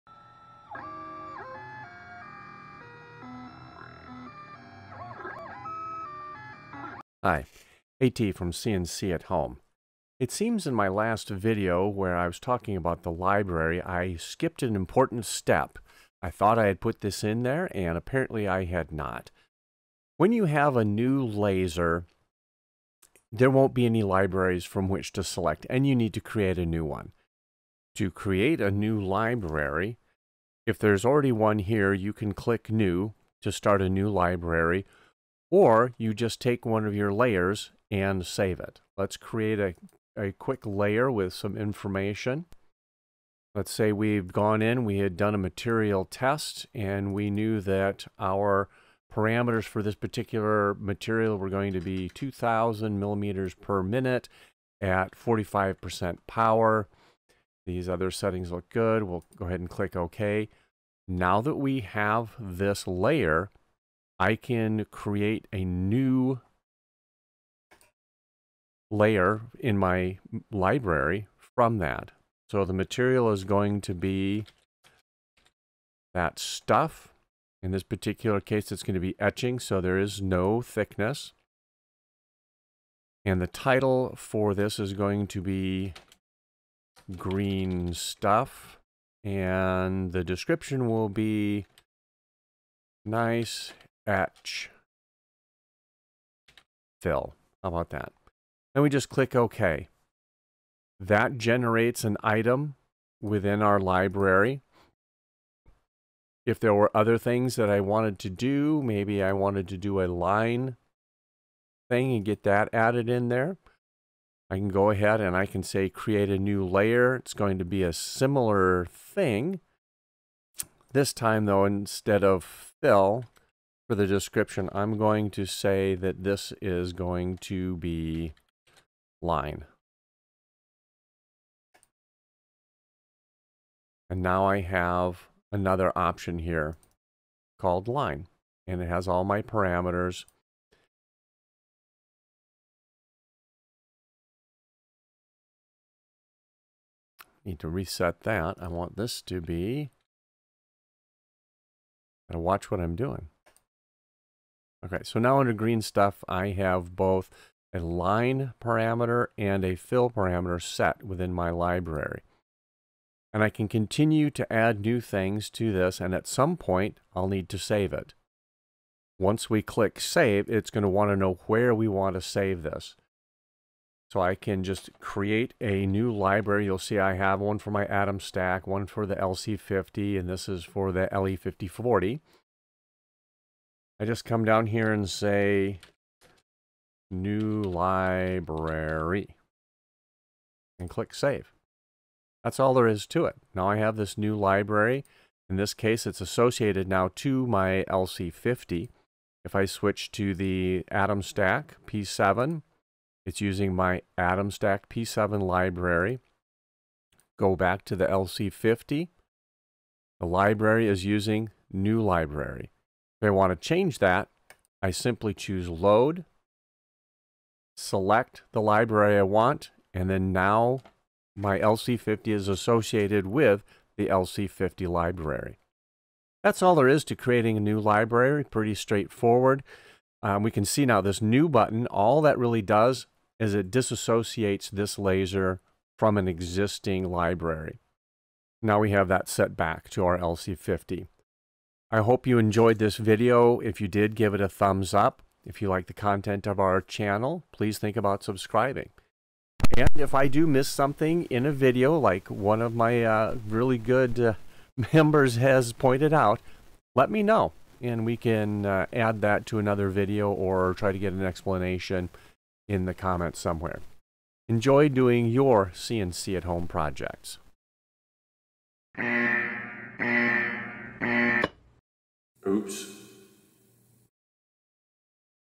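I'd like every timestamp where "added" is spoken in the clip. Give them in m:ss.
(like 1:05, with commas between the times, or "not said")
1:52.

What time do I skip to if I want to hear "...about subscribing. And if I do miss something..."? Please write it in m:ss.
4:07.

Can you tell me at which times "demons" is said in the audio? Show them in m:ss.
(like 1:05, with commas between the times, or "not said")
not said.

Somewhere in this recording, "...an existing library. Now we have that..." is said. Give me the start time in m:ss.
3:56.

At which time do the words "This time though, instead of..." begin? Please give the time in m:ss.
2:00.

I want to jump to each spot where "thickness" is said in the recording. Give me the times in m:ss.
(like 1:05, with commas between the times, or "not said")
1:20.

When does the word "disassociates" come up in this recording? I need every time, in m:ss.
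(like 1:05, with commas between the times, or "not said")
3:53.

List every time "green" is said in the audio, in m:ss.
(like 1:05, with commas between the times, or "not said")
1:27, 2:35.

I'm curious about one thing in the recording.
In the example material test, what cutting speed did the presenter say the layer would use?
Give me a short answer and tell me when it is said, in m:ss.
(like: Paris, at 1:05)
2,000 millimeters per minute, at 0:52.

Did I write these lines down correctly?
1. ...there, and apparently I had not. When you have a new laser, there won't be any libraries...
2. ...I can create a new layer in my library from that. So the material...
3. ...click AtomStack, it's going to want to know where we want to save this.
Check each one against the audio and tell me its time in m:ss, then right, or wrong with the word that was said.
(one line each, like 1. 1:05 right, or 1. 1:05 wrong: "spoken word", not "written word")
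1. 0:17 right
2. 1:04 right
3. 2:49 wrong: "Save", not "AtomStack".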